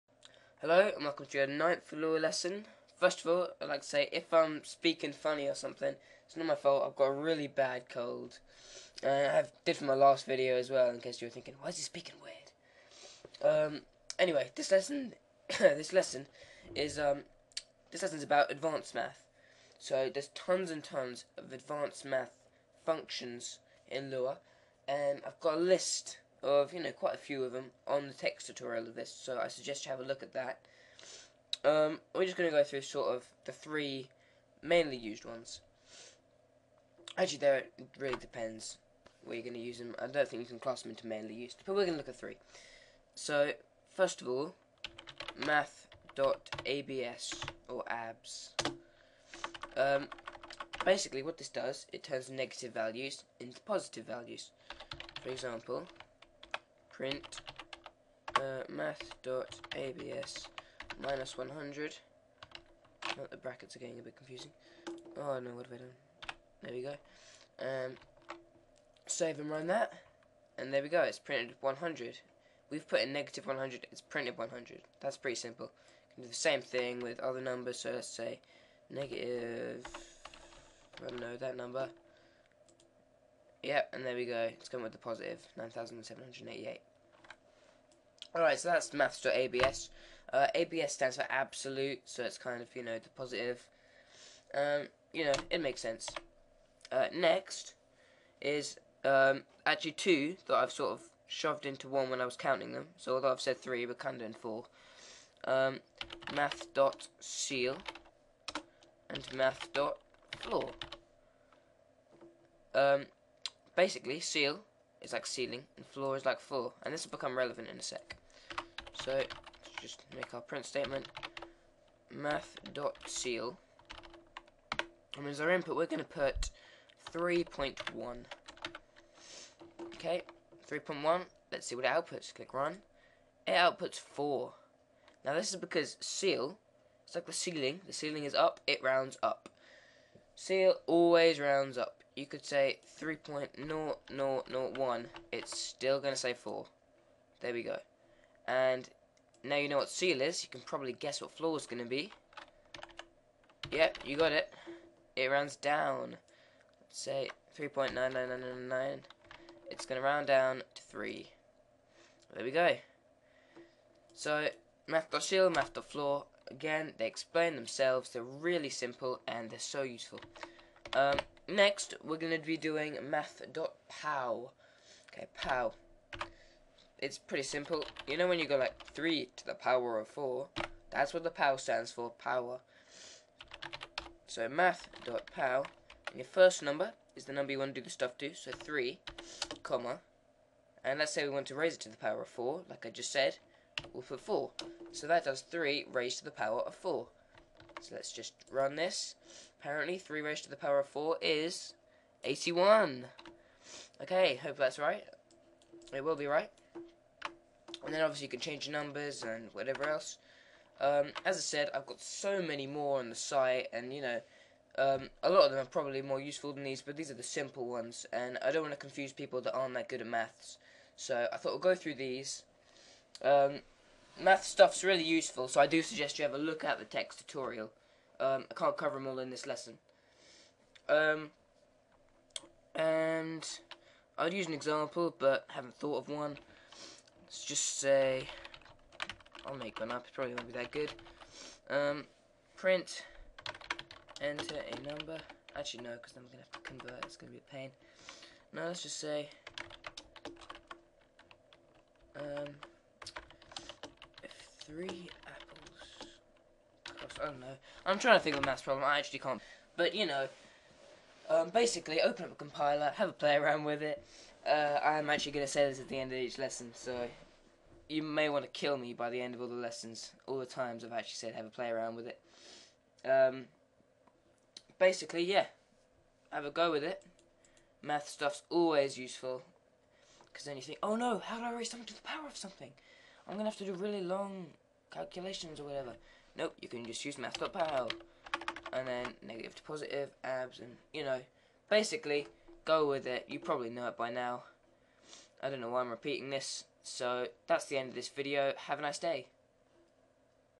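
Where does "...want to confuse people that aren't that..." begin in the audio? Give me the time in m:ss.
3:38.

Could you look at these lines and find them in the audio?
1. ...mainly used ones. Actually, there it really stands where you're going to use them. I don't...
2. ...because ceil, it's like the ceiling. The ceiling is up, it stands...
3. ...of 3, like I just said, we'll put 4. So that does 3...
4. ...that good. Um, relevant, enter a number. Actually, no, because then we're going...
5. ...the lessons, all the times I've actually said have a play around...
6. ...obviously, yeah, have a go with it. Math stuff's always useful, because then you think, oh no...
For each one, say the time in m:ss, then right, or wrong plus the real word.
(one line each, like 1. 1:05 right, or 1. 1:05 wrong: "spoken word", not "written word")
1. 0:34 wrong: "depends", not "stands"
2. 2:15 wrong: "rounds", not "stands"
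3. 3:12 wrong: "4", not "3"
4. 4:00 wrong: "print", not "relevant"
5. 4:29 right
6. 4:34 wrong: "basically", not "obviously".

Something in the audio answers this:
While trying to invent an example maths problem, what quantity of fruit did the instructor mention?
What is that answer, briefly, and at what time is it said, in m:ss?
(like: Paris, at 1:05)
Three apples, at 4:14.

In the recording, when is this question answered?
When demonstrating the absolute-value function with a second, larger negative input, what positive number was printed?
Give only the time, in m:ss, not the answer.
1:25.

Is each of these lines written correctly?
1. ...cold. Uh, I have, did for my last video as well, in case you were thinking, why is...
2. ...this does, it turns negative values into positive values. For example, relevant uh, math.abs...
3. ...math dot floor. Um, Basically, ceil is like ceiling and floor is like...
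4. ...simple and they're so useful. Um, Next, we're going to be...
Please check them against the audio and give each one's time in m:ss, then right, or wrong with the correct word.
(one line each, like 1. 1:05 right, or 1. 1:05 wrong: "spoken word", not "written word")
1. 0:07 right
2. 0:51 wrong: "print", not "relevant"
3. 1:49 right
4. 2:48 right.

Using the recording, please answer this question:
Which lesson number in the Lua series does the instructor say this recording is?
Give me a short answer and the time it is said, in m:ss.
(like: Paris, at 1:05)
Ninth, at 0:01.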